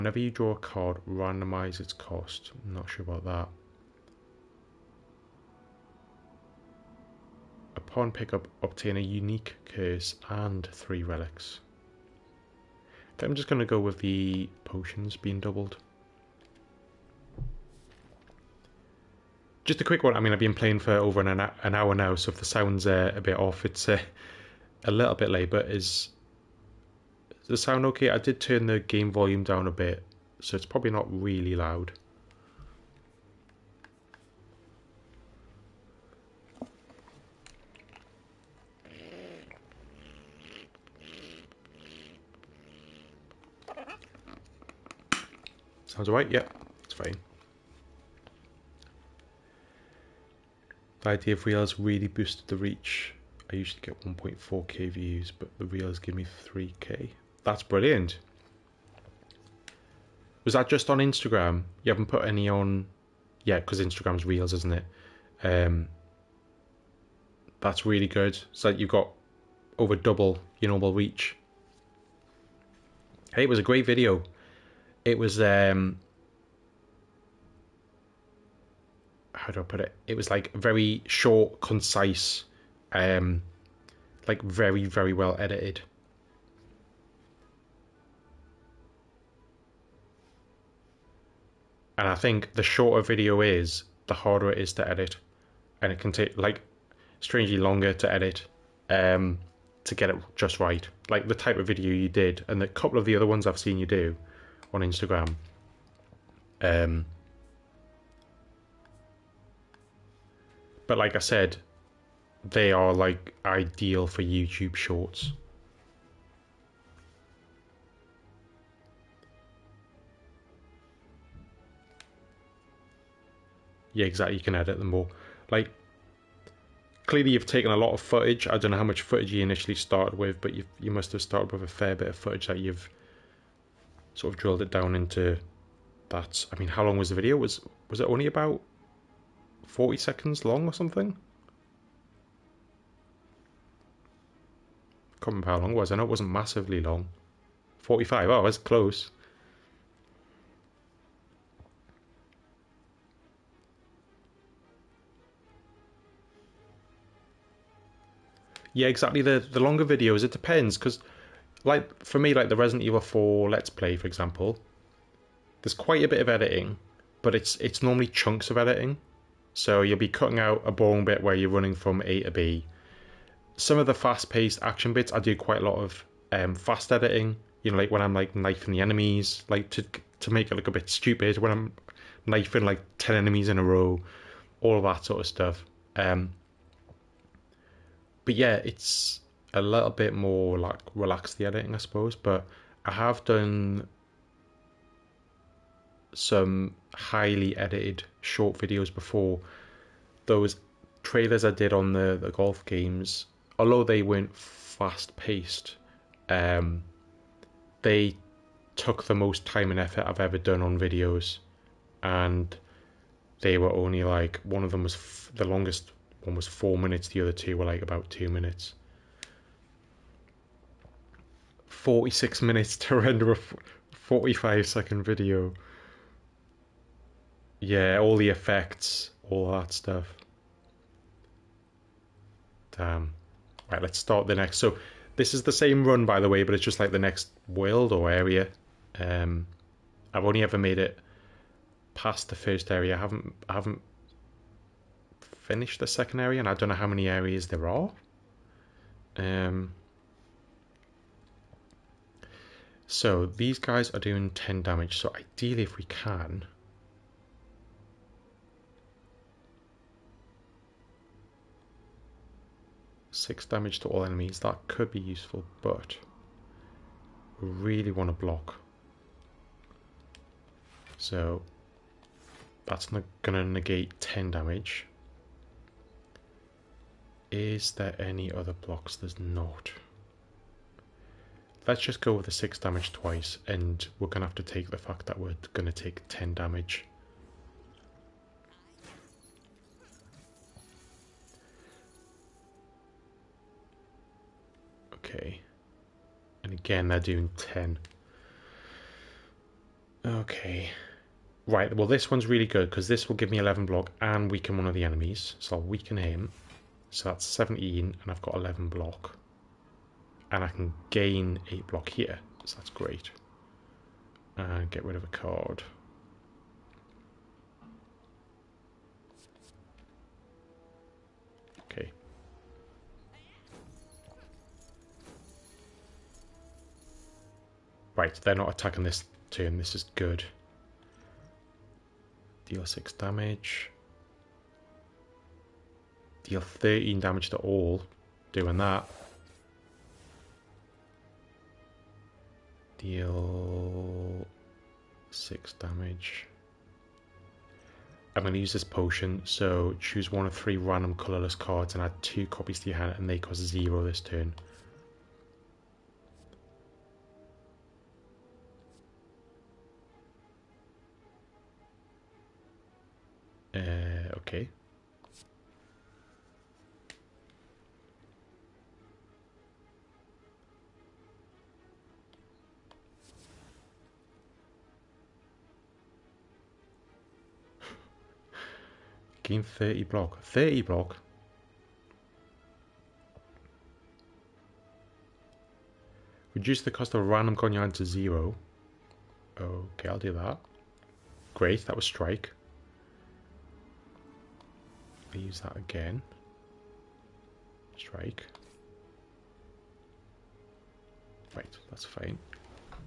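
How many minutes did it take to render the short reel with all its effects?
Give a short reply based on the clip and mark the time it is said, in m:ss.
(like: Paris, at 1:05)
46, at 3:41.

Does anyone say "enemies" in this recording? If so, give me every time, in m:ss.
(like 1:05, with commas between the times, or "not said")
2:58, 3:03, 4:24, 5:04.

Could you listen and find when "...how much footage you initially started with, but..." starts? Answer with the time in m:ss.
2:08.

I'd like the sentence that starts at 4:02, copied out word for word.
I haven't, I haven't finished the second area, and I don't know how many areas there are.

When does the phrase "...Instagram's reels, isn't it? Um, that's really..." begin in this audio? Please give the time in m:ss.
1:03.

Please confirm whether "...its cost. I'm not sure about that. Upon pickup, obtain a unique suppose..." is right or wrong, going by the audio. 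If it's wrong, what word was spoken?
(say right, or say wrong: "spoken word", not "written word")
wrong: "curse", not "suppose".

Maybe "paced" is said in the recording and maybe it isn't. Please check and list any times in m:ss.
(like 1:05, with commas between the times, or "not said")
2:53, 3:25.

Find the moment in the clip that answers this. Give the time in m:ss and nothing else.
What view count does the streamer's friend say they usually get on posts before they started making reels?
0:54.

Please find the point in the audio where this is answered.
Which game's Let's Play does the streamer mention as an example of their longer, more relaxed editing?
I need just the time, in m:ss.
2:42.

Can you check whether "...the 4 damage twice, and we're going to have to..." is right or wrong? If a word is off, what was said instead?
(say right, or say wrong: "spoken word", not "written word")
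wrong: "6", not "4".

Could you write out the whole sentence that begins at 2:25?
I can't remember how long it was.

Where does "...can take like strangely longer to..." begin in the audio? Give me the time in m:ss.
1:35.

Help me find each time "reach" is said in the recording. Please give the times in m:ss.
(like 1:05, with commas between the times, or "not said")
0:52, 1:10.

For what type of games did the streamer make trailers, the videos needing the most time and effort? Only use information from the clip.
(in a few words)
golf games.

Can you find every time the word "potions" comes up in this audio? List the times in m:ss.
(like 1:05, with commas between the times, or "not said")
0:14, 5:48.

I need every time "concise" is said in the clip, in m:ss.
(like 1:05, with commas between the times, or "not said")
1:21.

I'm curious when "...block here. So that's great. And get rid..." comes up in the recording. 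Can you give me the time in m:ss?
5:11.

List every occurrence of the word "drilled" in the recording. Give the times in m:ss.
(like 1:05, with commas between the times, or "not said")
2:14.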